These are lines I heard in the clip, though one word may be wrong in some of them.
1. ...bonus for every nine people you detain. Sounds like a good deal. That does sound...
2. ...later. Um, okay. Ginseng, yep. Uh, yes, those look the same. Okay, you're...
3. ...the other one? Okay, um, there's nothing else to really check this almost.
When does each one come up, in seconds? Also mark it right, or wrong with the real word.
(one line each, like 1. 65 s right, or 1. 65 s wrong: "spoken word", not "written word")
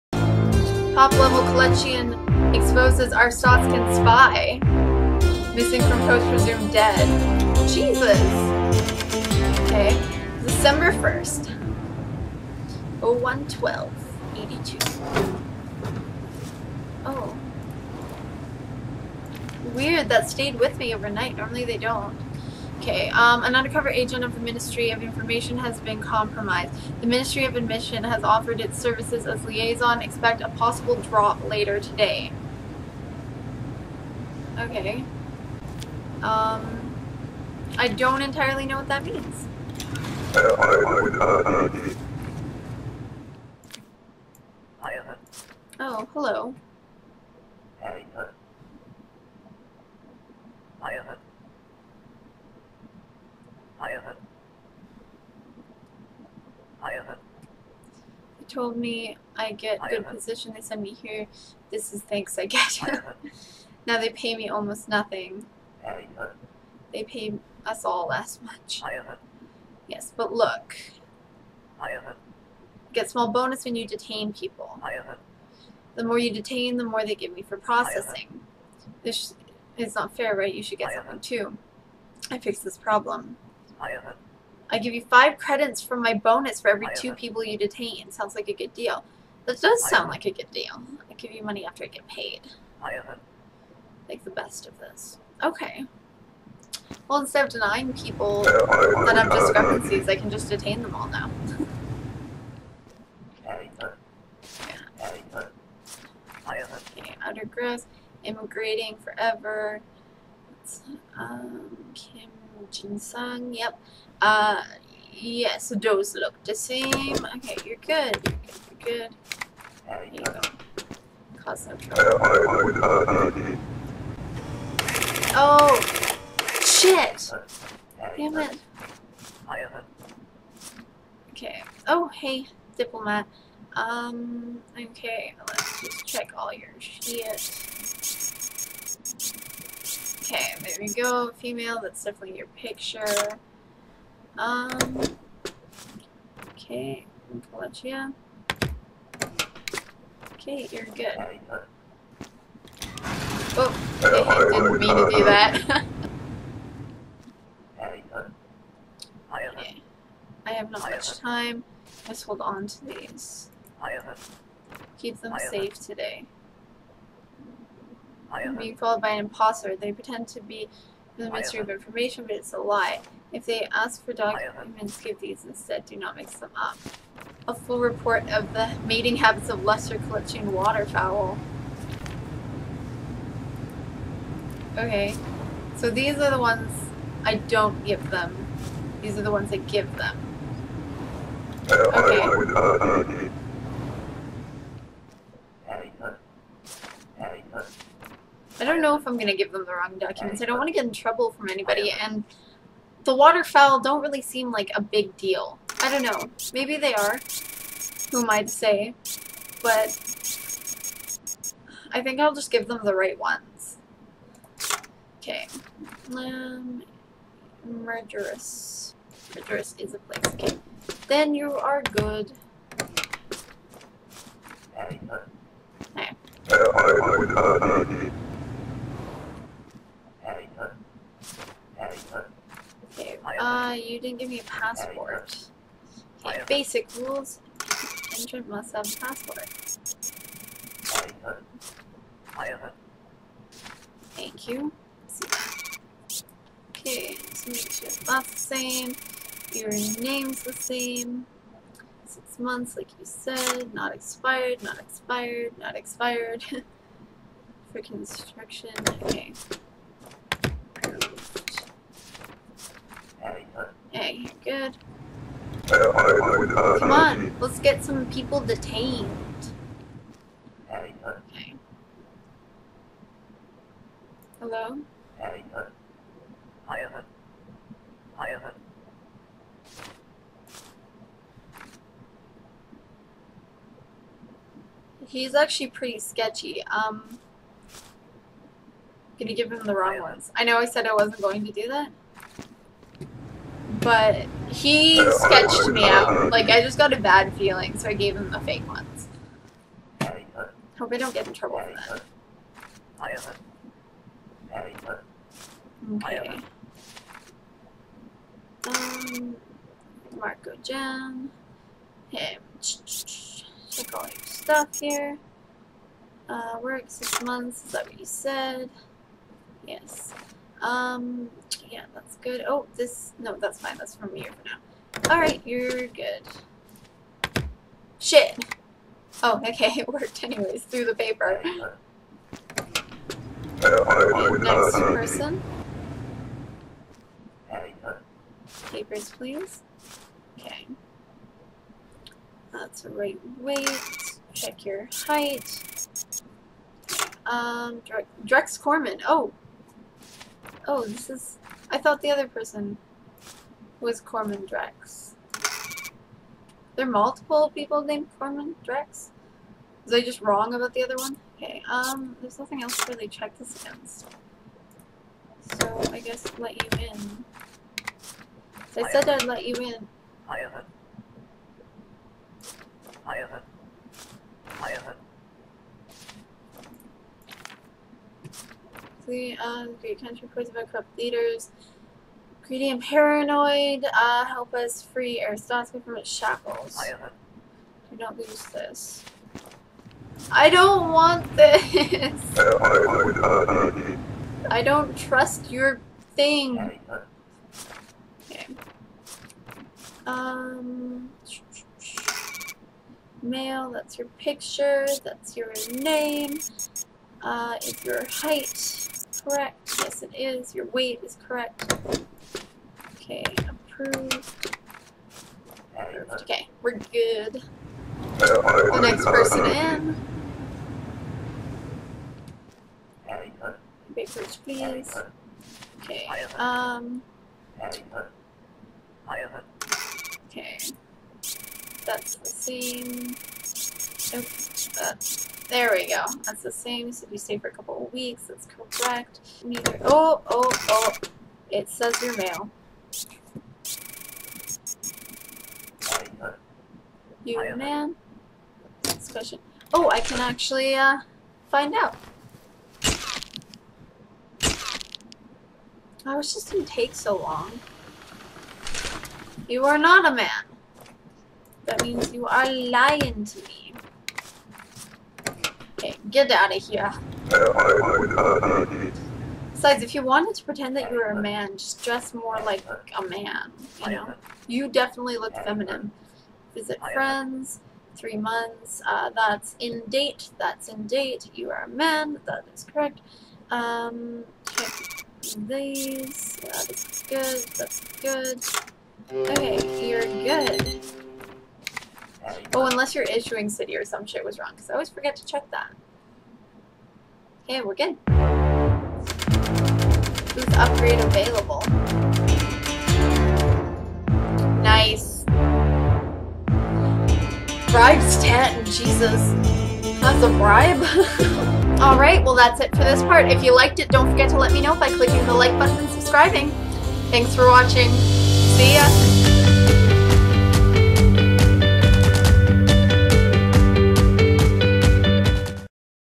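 1. 86 s wrong: "two", not "nine"
2. 109 s wrong: "forever", not "later"
3. 360 s wrong: "against", not "almost".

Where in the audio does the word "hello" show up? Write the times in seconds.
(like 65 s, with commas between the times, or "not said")
46 s, 274 s.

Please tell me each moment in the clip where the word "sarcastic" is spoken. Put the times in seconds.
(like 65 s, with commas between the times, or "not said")
not said.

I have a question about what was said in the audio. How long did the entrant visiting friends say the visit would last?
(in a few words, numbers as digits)
3 months.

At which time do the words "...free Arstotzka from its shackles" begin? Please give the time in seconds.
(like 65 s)
384 s.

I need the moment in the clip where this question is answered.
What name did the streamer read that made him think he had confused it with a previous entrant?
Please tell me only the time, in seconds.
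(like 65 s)
348 s.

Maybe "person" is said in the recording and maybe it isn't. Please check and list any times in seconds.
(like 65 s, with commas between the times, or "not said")
334 s, 352 s, 419 s.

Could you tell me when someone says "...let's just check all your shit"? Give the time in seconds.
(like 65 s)
135 s.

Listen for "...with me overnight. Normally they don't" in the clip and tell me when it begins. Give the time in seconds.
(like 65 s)
20 s.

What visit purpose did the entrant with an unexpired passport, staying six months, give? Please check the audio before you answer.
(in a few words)
Construction.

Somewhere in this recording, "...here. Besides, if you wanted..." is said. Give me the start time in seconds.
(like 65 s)
466 s.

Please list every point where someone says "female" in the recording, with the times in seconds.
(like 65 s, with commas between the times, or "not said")
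141 s.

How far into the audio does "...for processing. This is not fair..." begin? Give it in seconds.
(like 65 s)
77 s.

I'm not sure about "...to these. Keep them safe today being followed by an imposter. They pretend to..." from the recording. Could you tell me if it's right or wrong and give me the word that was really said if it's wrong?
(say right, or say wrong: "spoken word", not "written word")
right.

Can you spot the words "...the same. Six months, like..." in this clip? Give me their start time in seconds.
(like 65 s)
250 s.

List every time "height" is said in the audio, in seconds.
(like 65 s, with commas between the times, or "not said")
345 s, 408 s.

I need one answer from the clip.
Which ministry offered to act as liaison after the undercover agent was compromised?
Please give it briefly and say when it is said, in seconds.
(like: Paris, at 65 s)
Ministry of Admission, at 27 s.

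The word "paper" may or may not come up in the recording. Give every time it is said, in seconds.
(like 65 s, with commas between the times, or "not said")
330 s, 338 s.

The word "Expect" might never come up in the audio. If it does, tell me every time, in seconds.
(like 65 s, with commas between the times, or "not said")
30 s.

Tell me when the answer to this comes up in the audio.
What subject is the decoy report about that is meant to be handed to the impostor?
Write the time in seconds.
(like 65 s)
179 s.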